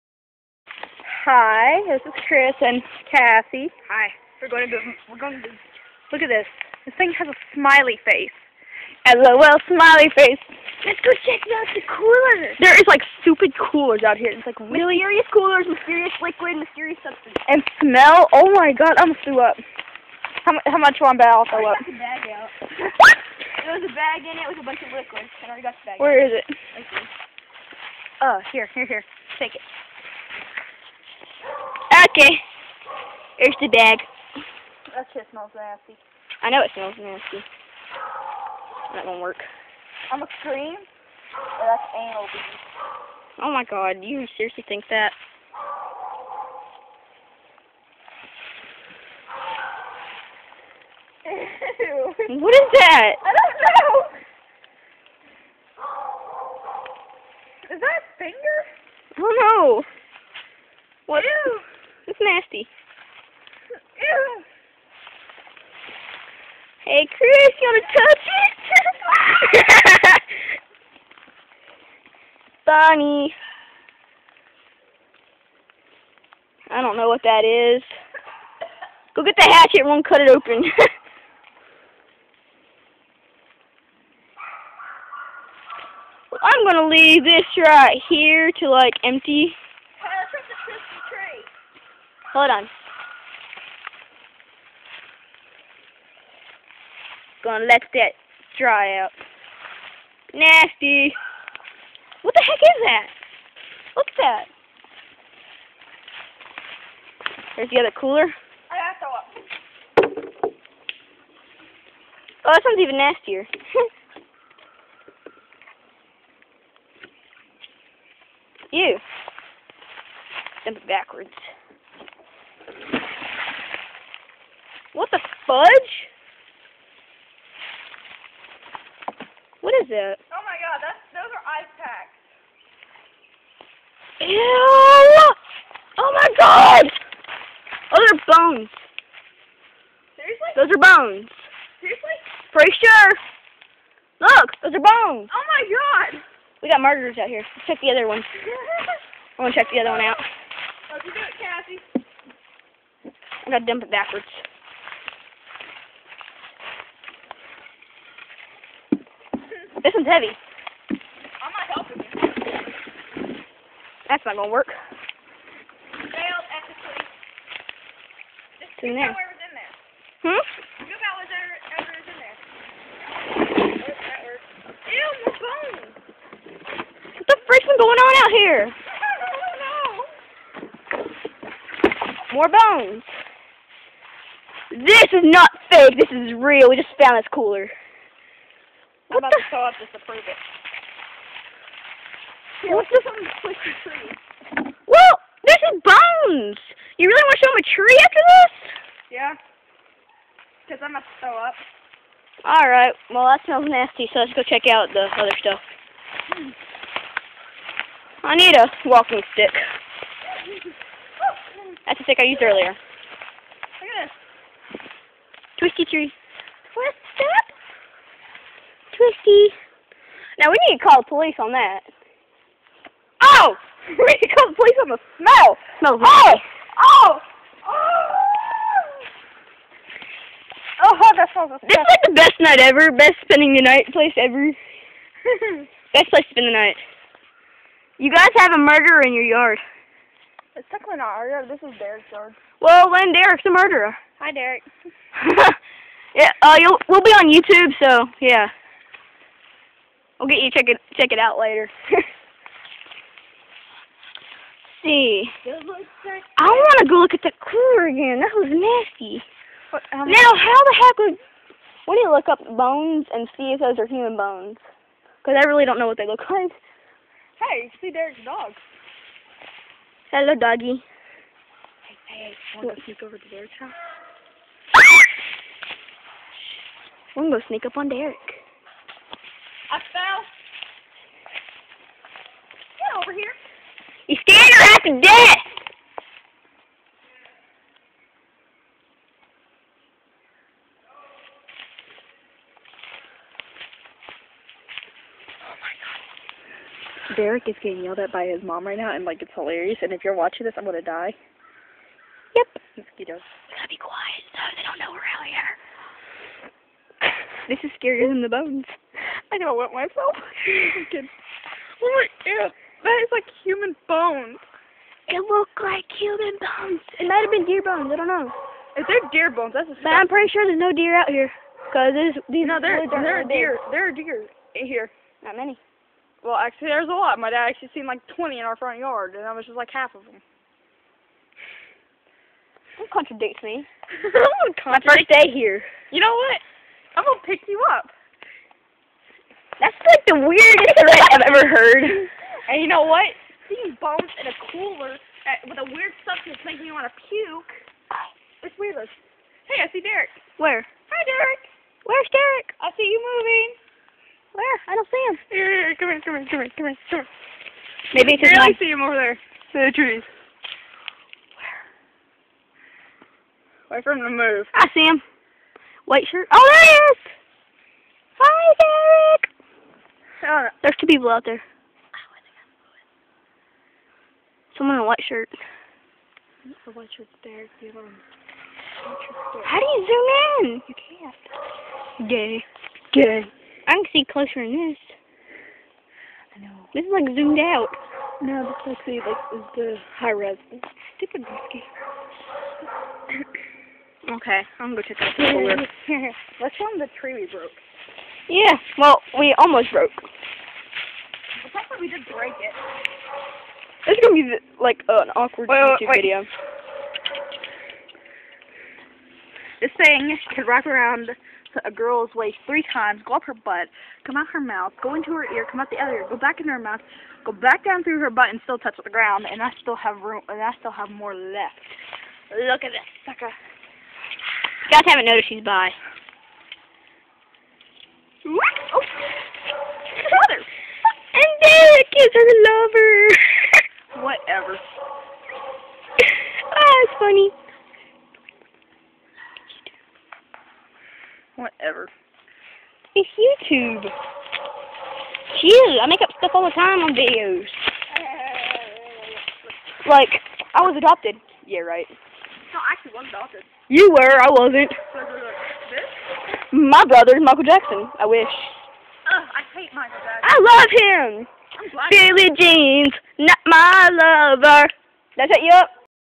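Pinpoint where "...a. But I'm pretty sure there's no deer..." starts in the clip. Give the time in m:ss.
5:19.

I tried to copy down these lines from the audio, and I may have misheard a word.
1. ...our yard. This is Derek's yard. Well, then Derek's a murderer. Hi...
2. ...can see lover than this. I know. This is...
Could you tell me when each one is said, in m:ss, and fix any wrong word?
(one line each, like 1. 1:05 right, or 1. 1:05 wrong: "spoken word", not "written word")
1. 4:01 right
2. 6:23 wrong: "closer", not "lover".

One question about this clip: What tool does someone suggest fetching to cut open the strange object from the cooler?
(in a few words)
Hatchet.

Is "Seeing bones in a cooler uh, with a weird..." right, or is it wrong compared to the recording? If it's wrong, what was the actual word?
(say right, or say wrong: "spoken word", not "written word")
right.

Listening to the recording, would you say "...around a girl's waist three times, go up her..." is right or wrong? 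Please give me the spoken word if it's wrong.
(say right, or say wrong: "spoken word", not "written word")
right.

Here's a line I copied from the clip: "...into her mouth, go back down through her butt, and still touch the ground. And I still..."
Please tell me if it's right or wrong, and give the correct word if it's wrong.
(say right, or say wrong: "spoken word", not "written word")
right.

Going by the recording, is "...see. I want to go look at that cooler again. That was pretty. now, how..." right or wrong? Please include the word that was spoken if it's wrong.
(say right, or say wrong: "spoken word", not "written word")
wrong: "nasty", not "pretty".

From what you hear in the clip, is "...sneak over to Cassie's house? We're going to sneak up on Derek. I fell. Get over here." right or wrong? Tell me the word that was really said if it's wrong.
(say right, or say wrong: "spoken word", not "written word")
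wrong: "Derek", not "Cassie".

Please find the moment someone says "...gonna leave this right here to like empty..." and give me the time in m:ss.
1:26.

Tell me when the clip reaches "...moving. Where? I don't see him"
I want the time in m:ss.
5:52.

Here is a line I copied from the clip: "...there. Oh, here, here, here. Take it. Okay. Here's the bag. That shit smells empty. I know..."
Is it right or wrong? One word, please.
wrong.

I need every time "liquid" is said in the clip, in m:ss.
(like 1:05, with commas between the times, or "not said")
0:16, 0:24.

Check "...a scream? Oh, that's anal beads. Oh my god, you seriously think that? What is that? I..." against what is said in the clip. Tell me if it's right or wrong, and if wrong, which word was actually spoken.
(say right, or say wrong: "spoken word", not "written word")
right.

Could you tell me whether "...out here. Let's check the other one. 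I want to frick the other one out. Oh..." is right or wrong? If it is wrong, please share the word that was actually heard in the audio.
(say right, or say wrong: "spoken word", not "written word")
wrong: "check", not "frick".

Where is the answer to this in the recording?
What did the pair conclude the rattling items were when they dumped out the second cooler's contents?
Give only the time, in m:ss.
2:11.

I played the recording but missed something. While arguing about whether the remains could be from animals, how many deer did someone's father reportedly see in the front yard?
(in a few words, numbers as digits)
20.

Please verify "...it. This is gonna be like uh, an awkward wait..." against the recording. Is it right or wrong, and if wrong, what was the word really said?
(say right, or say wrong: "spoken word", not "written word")
right.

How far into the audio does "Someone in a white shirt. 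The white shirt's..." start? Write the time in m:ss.
6:14.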